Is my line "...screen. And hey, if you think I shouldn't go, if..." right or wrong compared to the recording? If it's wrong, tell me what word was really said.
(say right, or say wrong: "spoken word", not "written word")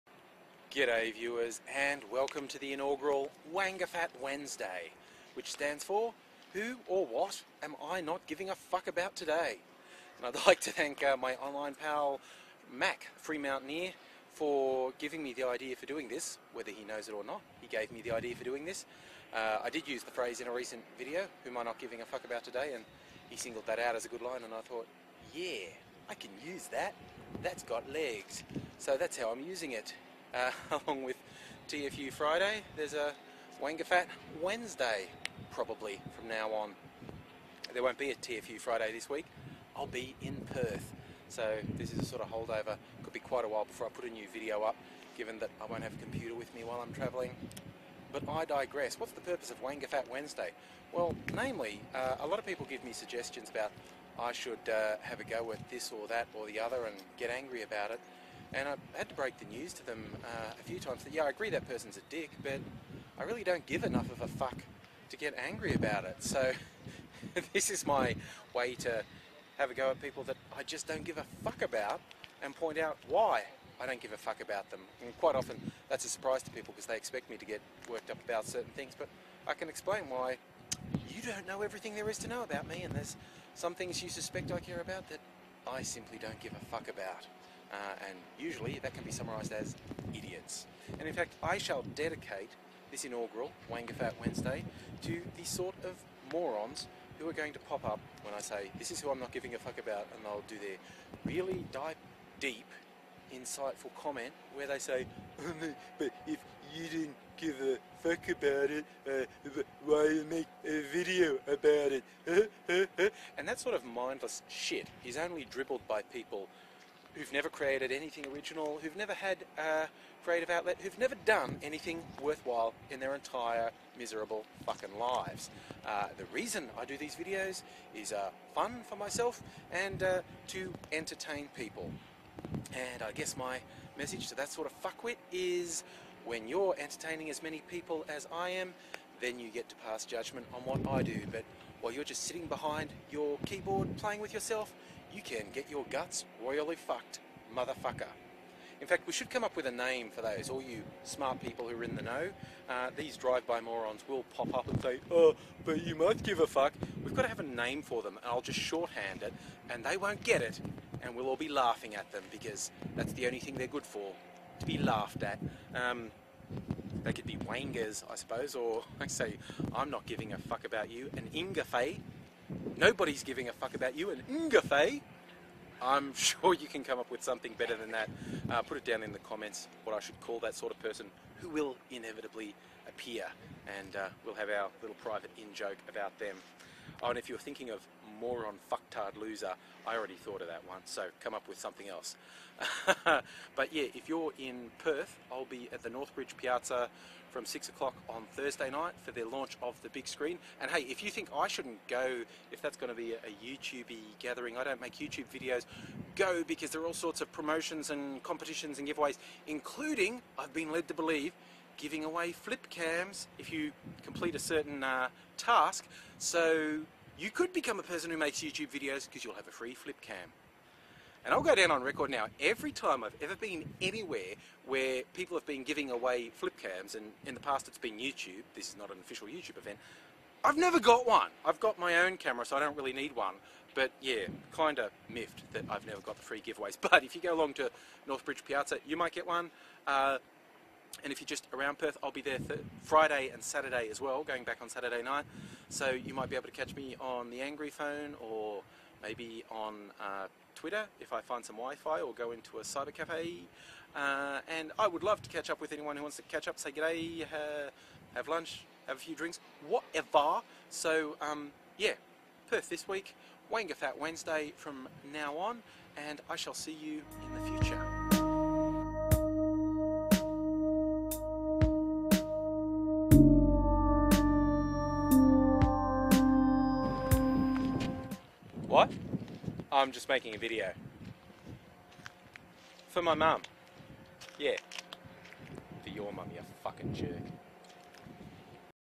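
right.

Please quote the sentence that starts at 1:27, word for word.
Uh, and usually that can be summarised as idiots.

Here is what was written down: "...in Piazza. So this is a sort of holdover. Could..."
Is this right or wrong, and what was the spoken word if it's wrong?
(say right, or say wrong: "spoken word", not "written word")
wrong: "Perth", not "Piazza".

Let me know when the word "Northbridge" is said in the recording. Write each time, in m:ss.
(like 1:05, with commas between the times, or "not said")
3:15, 3:58.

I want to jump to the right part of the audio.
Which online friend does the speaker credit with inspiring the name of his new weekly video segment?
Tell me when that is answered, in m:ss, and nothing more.
0:12.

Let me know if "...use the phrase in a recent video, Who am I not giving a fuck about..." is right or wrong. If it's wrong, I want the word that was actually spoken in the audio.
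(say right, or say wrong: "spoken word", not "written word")
right.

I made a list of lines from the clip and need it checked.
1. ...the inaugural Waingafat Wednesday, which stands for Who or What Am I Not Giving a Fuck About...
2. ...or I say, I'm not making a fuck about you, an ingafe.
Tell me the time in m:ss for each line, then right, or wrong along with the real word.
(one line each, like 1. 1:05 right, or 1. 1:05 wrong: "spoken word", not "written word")
1. 0:02 right
2. 2:48 wrong: "giving", not "making".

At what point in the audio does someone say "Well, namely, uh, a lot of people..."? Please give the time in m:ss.
0:50.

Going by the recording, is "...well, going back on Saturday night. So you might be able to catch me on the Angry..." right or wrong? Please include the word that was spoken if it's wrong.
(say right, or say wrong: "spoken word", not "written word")
right.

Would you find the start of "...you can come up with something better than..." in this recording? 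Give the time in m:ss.
2:56.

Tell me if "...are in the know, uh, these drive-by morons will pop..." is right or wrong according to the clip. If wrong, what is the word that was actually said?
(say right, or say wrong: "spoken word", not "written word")
right.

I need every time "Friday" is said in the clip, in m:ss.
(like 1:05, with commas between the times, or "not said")
0:32, 0:38, 4:02.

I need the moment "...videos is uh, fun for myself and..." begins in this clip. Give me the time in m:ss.
2:07.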